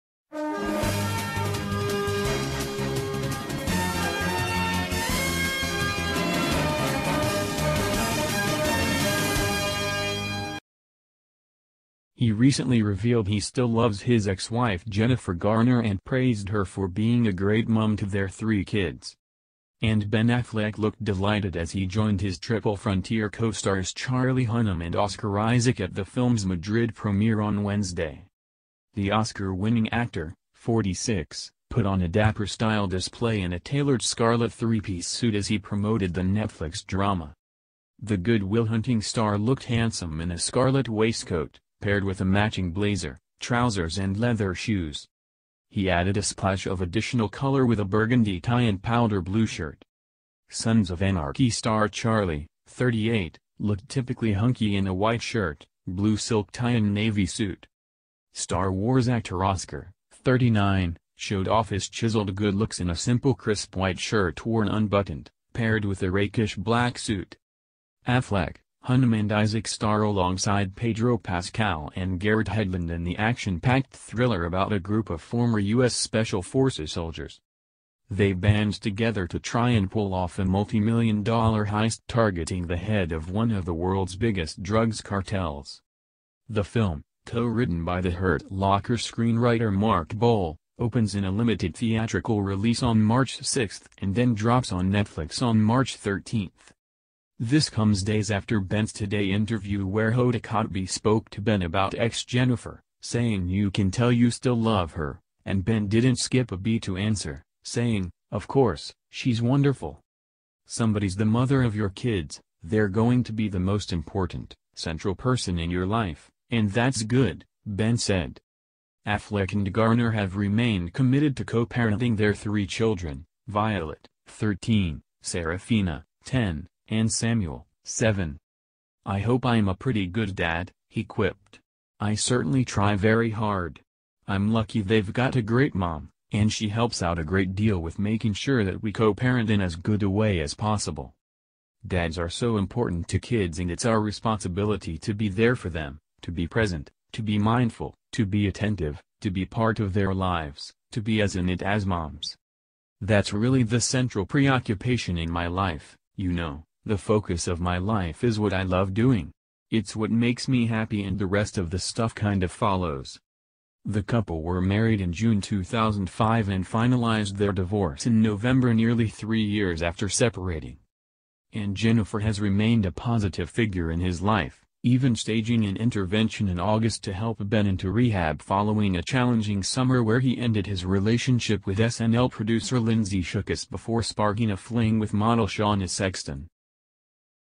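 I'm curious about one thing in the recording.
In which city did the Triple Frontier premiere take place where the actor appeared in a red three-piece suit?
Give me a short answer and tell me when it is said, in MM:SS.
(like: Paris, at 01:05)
Madrid, at 00:26.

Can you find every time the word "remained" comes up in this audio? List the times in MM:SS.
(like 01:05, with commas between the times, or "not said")
02:00, 02:52.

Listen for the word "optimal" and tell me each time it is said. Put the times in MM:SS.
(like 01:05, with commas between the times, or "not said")
not said.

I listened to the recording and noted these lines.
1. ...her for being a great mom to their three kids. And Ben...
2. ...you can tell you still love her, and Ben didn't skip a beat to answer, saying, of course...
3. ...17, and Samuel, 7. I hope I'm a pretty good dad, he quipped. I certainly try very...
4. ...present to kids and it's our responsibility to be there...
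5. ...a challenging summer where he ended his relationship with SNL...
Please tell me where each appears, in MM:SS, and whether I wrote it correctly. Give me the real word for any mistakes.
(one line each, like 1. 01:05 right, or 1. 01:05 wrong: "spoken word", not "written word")
1. 00:16 right
2. 01:43 right
3. 02:06 wrong: "10", not "17"
4. 02:22 wrong: "important", not "present"
5. 02:58 right.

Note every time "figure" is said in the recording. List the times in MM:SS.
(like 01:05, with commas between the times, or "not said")
02:53.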